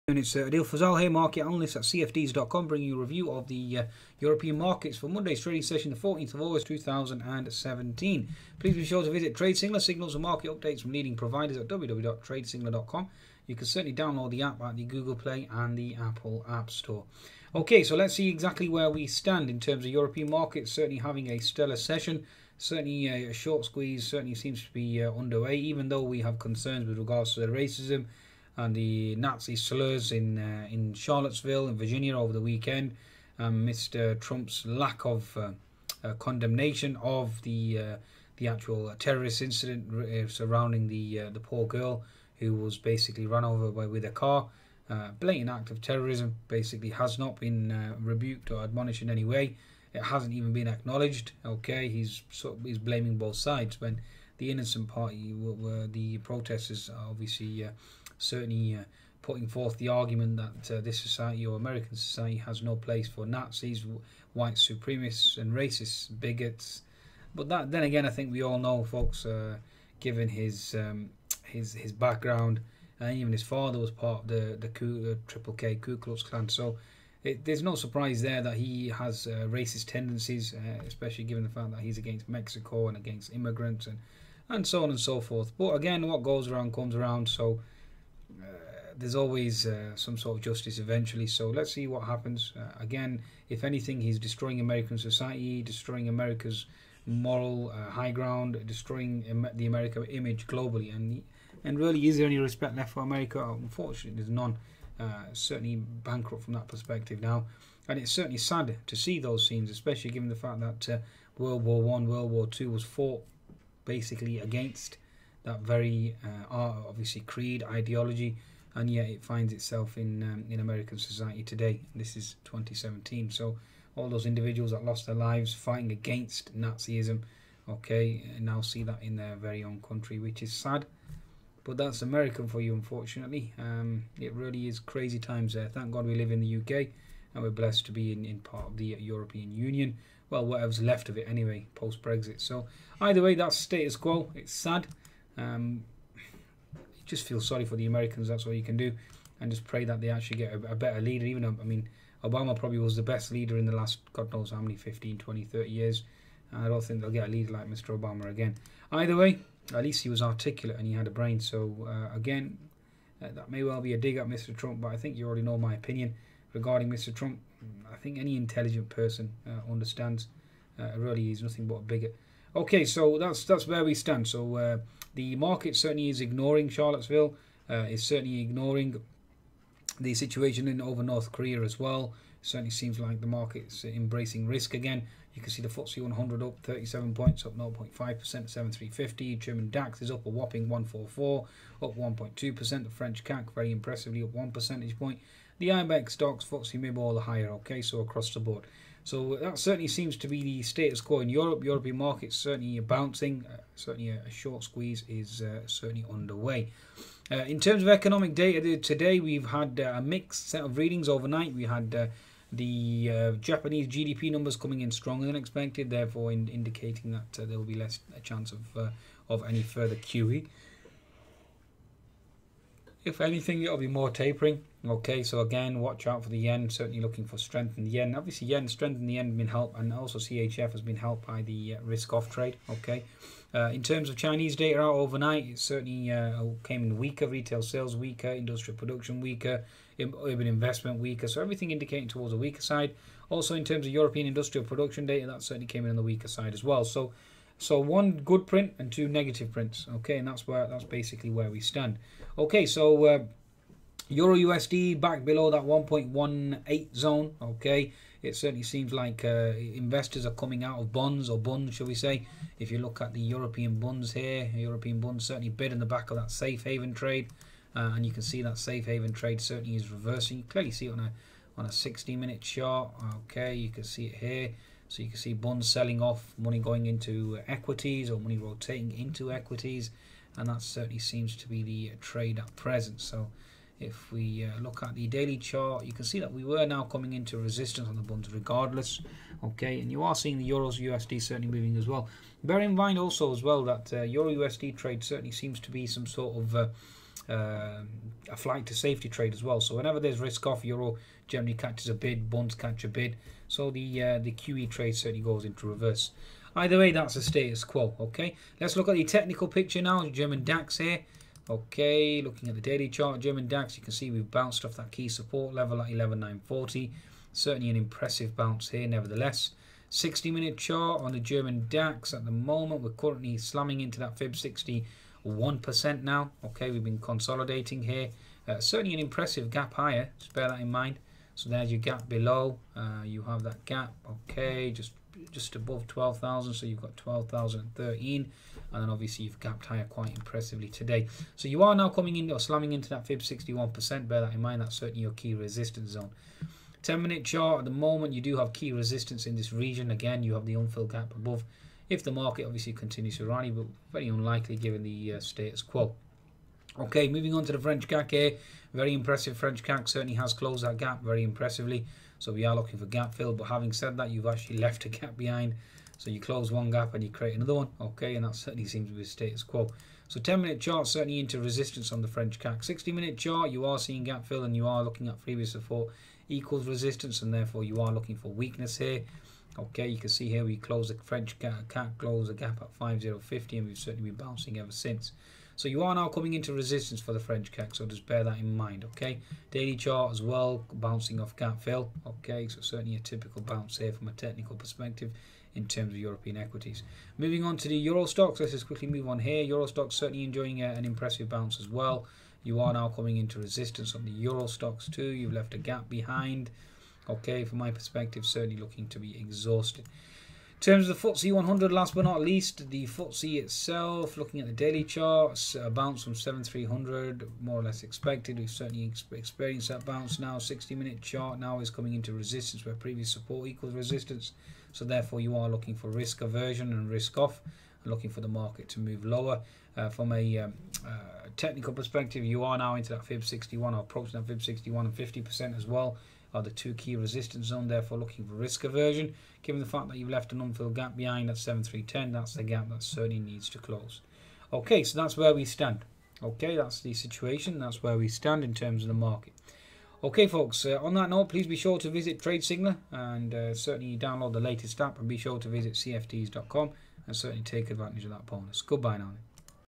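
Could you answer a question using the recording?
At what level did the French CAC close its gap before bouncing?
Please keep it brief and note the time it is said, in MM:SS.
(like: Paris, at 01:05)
5050, at 06:22.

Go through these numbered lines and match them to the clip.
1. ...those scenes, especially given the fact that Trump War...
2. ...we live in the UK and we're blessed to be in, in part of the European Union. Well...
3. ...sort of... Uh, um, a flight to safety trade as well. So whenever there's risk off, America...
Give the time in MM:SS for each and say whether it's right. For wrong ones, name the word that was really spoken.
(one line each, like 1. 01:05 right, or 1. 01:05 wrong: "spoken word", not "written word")
1. 01:49 wrong: "World", not "Trump"
2. 02:16 right
3. 04:56 wrong: "Euro", not "America".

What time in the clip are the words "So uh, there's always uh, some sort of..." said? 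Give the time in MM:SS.
01:27.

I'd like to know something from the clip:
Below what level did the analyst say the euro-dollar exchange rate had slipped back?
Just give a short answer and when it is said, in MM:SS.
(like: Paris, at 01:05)
1.18, at 04:15.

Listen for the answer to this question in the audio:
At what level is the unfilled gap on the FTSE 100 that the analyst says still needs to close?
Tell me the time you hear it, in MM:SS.
07:21.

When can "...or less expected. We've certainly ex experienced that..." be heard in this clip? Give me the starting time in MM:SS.
06:57.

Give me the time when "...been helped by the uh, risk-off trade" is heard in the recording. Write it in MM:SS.
03:50.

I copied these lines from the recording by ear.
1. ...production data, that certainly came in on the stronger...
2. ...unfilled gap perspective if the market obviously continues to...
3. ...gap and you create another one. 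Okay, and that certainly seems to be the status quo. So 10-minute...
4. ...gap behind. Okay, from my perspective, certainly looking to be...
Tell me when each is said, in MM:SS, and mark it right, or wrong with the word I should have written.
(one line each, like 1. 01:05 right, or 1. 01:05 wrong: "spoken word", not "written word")
1. 04:04 wrong: "weaker", not "stronger"
2. 05:50 wrong: "above", not "perspective"
3. 06:06 right
4. 06:45 right.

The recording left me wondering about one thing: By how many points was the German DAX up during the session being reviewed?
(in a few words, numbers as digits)
144.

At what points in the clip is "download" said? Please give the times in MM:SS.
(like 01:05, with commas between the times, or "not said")
00:13, 07:33.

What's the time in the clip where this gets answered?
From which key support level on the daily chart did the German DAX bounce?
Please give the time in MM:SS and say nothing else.
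05:15.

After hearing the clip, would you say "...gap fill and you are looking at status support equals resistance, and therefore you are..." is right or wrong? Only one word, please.
wrong.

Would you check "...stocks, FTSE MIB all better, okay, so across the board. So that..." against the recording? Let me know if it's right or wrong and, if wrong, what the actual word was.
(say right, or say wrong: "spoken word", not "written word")
wrong: "higher", not "better".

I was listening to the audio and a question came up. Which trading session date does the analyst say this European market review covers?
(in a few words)
14 August 2017.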